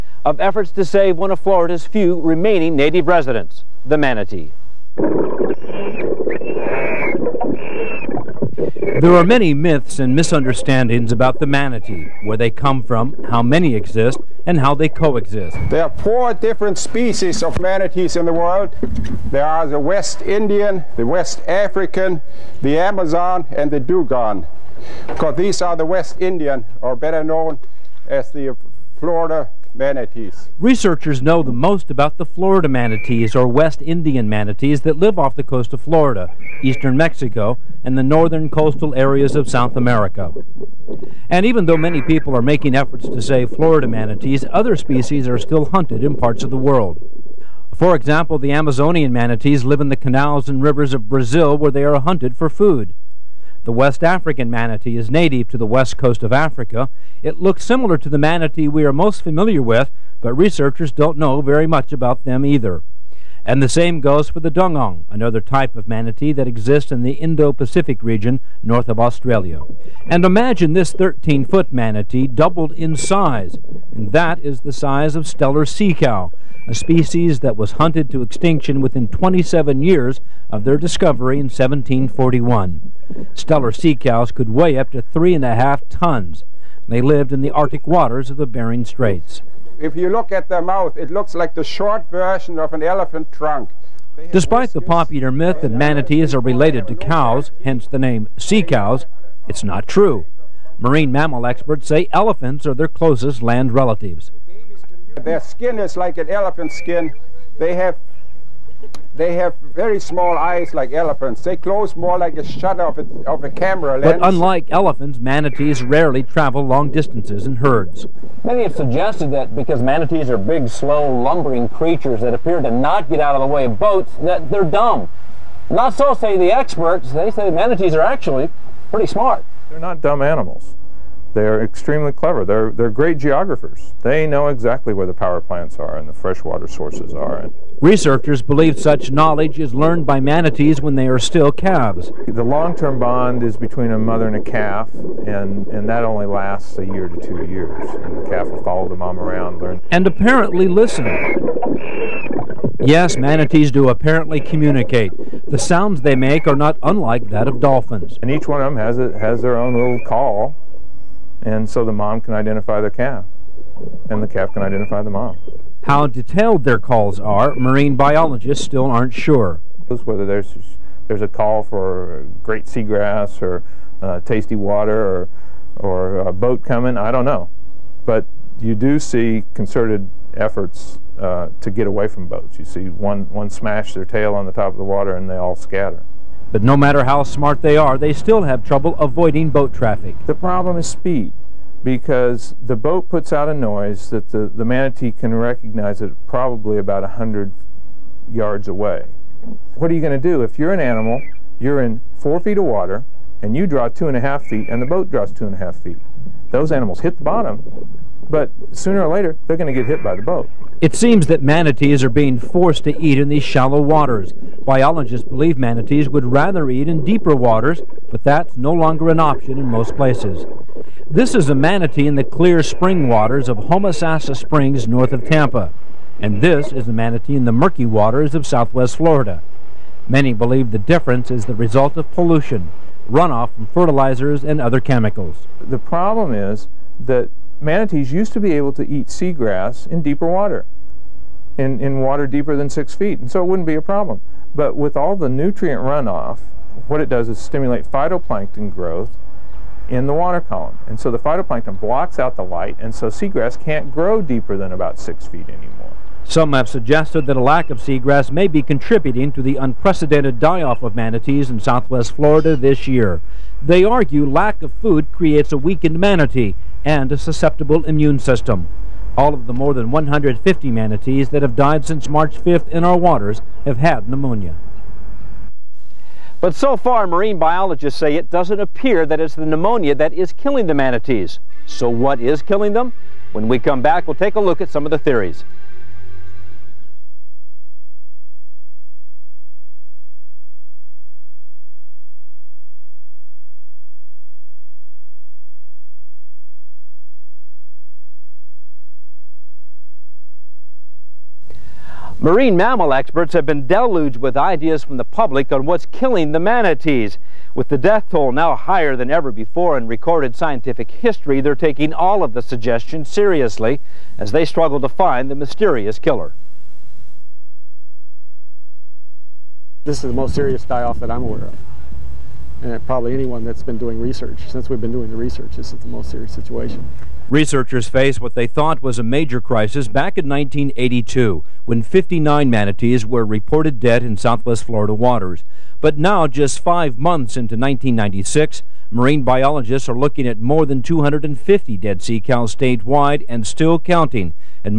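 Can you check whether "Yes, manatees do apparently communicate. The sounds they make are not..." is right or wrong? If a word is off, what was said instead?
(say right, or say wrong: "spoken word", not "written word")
right.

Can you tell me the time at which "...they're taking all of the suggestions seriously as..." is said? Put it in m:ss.
5:11.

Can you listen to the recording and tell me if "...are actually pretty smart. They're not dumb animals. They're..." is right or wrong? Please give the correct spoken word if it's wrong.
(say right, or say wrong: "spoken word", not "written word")
right.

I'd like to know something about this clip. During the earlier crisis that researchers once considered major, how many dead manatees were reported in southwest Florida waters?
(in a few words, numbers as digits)
59.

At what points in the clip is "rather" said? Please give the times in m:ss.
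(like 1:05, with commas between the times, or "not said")
3:36.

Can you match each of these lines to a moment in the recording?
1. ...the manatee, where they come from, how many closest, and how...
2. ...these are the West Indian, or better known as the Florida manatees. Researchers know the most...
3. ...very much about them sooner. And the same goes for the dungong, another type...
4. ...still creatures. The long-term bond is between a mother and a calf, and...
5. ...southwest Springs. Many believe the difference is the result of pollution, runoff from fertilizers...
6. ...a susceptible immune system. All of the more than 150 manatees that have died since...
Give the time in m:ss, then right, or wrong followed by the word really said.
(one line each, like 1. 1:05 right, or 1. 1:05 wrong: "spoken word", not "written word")
1. 0:11 wrong: "exist", not "closest"
2. 0:25 right
3. 1:01 wrong: "either", not "sooner"
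4. 2:21 wrong: "calves", not "creatures"
5. 3:48 wrong: "Florida", not "Springs"
6. 4:27 right.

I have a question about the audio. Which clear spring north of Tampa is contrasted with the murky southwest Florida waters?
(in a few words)
Homosassa Springs.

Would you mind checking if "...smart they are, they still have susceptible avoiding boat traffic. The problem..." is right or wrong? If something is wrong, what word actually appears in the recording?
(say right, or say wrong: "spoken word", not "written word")
wrong: "trouble", not "susceptible".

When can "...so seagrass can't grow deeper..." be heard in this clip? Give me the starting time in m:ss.
4:12.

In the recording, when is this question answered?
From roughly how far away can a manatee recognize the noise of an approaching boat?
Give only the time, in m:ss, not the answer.
3:17.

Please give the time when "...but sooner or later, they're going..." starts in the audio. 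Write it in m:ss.
3:28.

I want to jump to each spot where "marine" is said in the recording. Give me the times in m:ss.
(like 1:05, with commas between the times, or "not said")
1:40, 2:47, 4:37, 5:02, 5:38.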